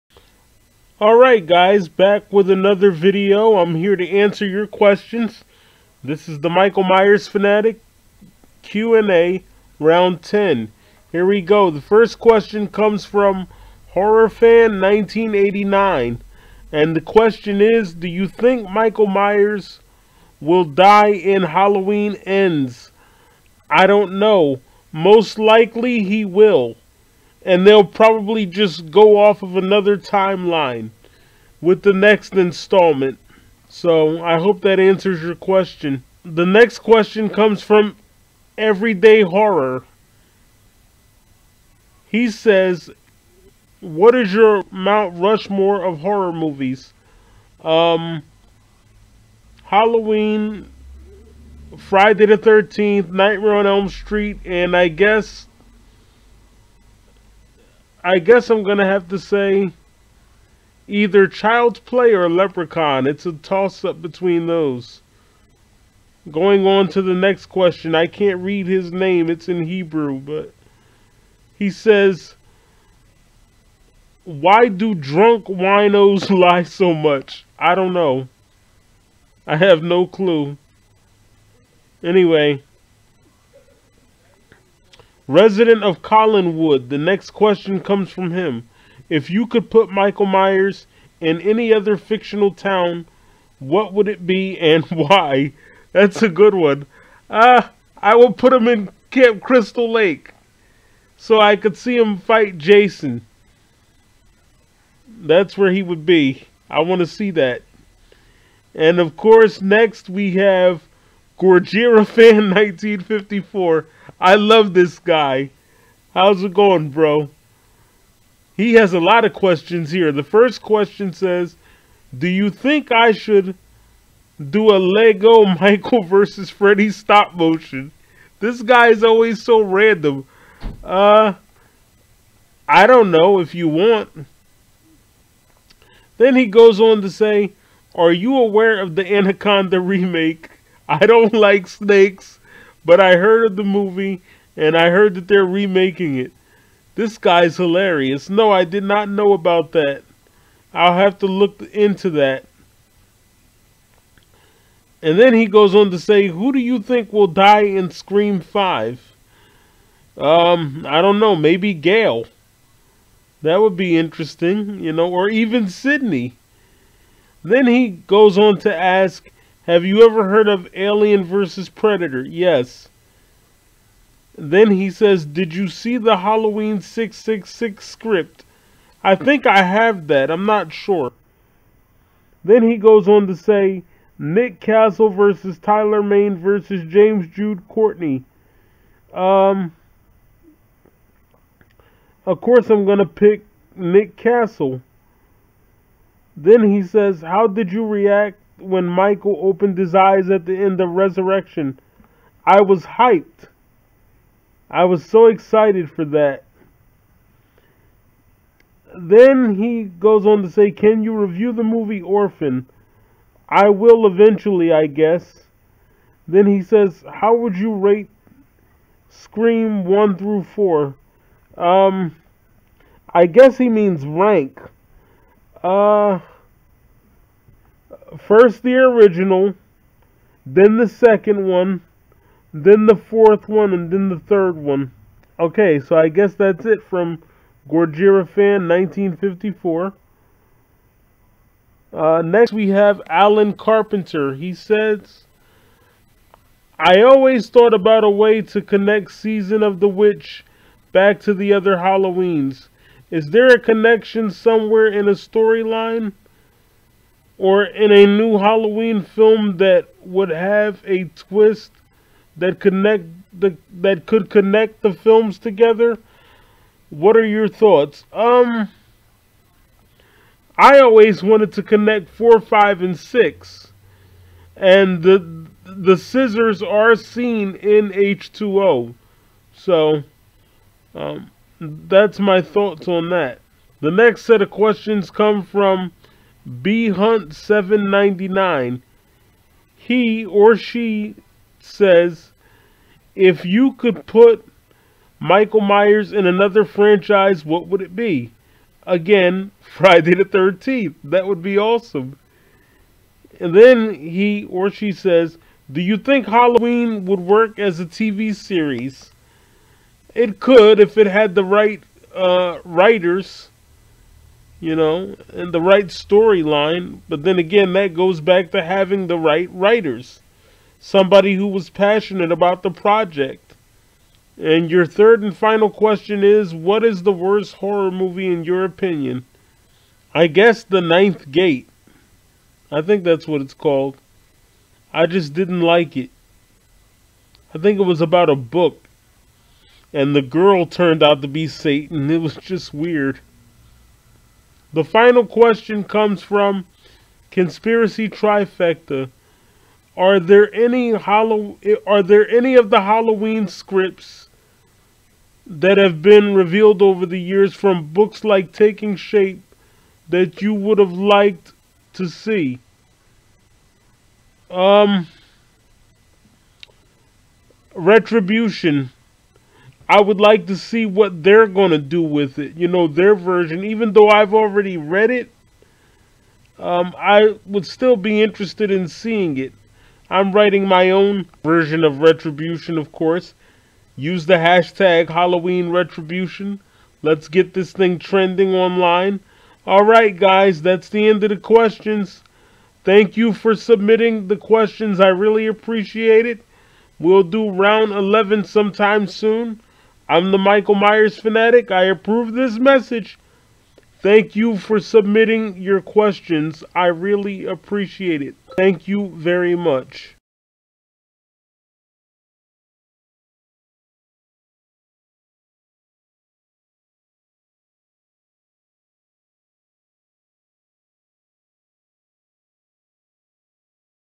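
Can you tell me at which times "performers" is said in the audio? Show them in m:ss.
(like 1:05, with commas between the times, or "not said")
not said.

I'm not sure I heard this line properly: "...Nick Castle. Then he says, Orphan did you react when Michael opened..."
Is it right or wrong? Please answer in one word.
wrong.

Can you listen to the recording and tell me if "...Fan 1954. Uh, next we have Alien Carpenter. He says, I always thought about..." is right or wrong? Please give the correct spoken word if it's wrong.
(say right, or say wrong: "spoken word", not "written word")
wrong: "Alan", not "Alien".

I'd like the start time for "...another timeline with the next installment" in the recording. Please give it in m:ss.
0:29.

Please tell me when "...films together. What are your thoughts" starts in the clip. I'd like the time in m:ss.
4:24.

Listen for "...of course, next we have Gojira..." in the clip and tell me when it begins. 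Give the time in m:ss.
1:48.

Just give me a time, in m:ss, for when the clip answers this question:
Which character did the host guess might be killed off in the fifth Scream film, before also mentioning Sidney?
2:41.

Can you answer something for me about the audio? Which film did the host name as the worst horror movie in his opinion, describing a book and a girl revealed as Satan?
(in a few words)
The Ninth Gate.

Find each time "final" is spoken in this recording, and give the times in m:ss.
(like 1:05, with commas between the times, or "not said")
5:25, 5:44.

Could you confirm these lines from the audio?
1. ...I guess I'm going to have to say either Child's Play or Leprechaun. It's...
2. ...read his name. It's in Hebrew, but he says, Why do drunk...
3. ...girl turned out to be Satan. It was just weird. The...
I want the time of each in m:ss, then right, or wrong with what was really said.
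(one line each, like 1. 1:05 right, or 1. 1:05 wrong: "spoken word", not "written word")
1. 0:58 right
2. 1:08 right
3. 5:40 right.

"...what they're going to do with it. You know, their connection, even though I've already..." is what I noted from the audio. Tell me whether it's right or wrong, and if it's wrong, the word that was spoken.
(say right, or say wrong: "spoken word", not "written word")
wrong: "version", not "connection".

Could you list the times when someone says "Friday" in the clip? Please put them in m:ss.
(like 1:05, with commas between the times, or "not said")
0:51, 4:59.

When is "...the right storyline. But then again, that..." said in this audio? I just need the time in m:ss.
5:15.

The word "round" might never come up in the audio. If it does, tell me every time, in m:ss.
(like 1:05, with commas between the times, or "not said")
0:09, 6:37.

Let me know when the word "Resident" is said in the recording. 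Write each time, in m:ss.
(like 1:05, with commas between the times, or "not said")
1:25.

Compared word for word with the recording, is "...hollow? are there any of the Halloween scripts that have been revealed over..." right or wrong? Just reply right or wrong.
right.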